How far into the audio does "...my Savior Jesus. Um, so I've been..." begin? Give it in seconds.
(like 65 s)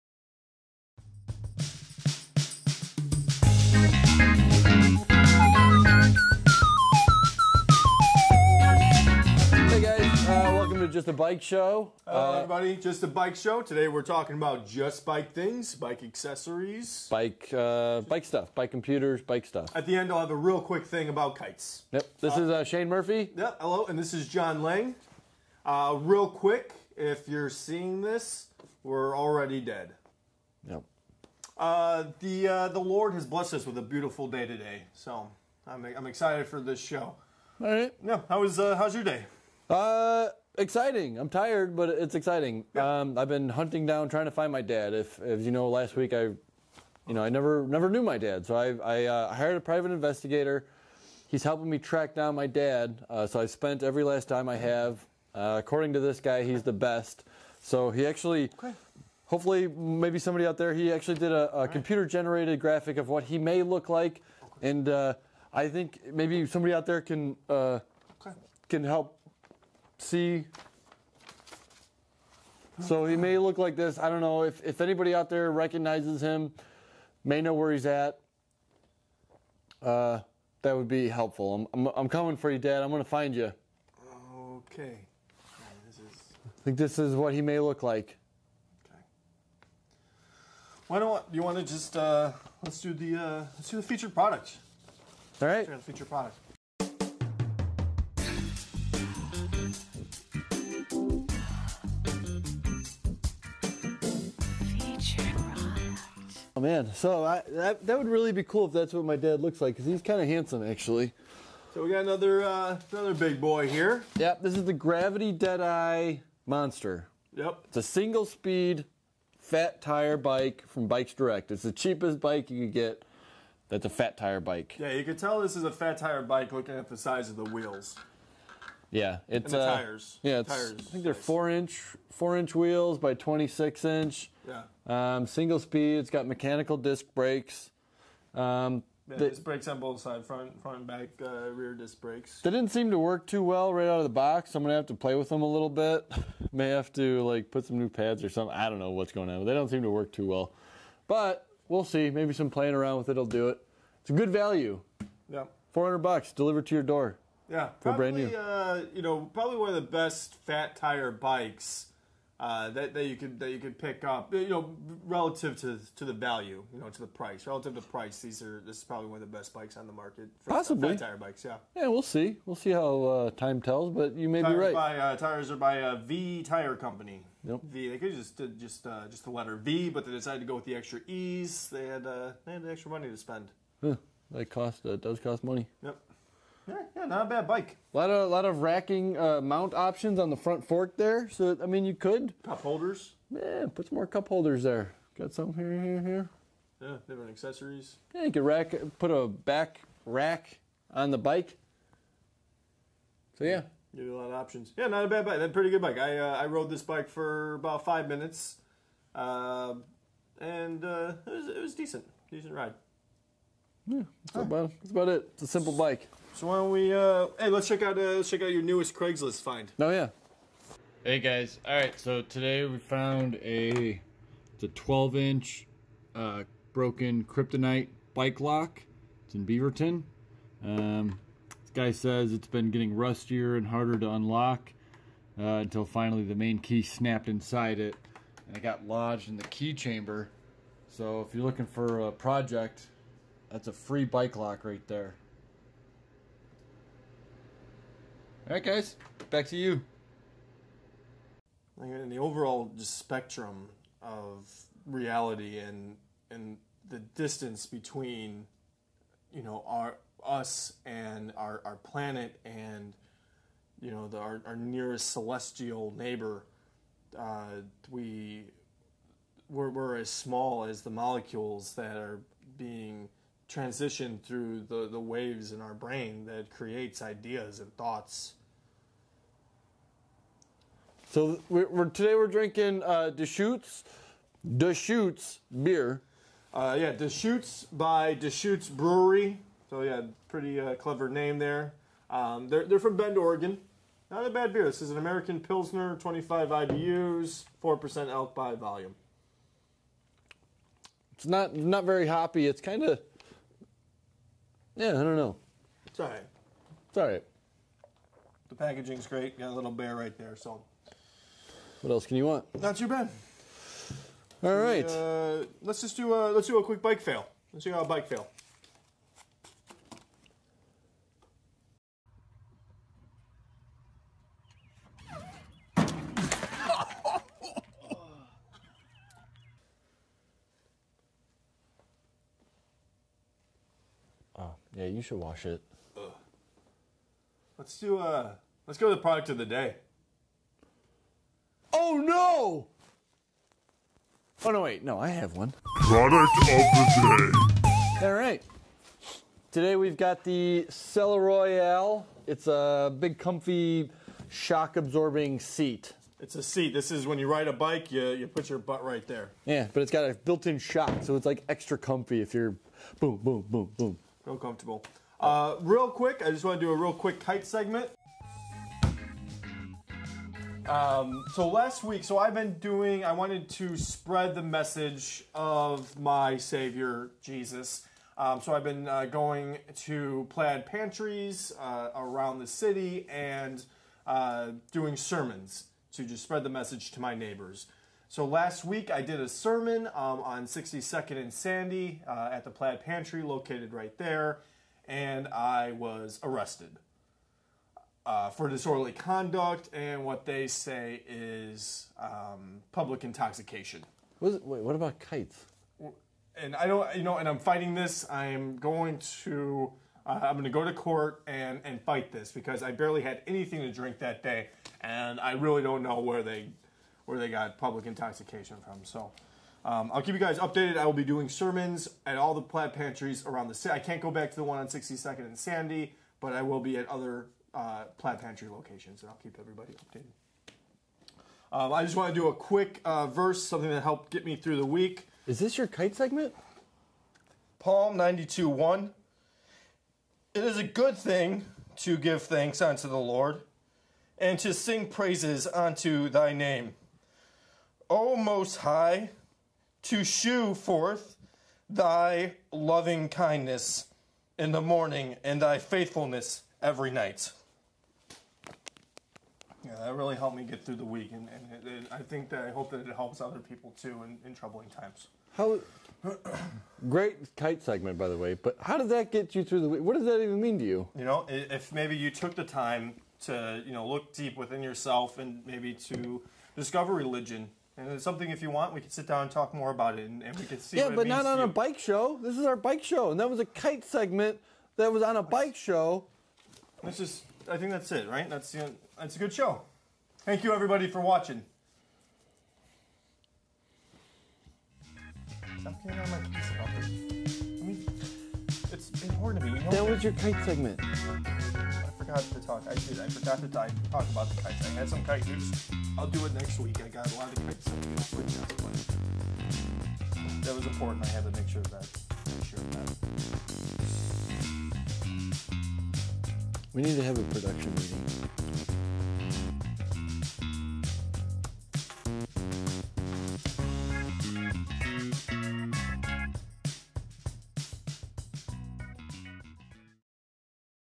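375 s.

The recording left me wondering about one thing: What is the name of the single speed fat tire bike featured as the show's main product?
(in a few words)
Gravity Deadeye Monster.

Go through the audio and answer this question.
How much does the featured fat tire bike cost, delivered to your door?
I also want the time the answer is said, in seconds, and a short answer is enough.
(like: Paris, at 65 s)
$400, at 155 s.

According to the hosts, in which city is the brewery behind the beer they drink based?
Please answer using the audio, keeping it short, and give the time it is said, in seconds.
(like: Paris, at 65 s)
Bend, Oregon, at 292 s.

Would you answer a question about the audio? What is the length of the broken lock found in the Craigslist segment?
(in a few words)
12 inch.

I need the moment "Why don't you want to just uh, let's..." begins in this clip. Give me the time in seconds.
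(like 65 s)
90 s.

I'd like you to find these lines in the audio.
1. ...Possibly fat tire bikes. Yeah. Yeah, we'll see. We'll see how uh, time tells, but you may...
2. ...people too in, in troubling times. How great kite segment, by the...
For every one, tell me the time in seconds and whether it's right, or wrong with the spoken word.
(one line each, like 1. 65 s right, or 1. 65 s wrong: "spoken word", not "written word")
1. 170 s right
2. 463 s right.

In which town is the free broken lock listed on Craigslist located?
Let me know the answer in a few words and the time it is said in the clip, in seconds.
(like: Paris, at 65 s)
Beaverton, at 229 s.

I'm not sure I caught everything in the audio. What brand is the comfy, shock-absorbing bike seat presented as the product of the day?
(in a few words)
Selle Royal.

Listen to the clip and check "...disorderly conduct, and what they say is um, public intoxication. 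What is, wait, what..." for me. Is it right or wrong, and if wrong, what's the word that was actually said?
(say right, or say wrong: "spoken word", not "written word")
right.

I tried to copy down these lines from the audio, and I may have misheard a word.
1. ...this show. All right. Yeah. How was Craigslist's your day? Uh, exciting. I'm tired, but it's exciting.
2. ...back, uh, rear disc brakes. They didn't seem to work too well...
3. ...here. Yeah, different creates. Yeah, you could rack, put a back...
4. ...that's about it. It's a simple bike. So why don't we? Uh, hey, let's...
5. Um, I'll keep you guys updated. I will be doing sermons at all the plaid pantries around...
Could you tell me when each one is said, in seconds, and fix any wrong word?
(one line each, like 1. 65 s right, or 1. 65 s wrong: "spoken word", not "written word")
1. 36 s wrong: "How", not "Craigslist"
2. 140 s right
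3. 196 s wrong: "accessories", not "creates"
4. 214 s right
5. 419 s right.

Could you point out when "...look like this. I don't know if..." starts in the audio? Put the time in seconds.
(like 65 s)
73 s.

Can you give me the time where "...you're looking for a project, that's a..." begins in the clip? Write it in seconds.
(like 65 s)
241 s.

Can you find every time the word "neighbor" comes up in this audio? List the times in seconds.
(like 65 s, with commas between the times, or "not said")
265 s, 387 s.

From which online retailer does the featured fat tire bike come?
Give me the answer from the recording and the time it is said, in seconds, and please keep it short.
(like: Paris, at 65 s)
Bikes Direct, at 120 s.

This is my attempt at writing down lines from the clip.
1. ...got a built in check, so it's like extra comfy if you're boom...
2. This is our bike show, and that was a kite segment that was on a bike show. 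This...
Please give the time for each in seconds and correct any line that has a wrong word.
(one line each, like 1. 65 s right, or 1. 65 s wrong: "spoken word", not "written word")
1. 359 s wrong: "shock", not "check"
2. 482 s right.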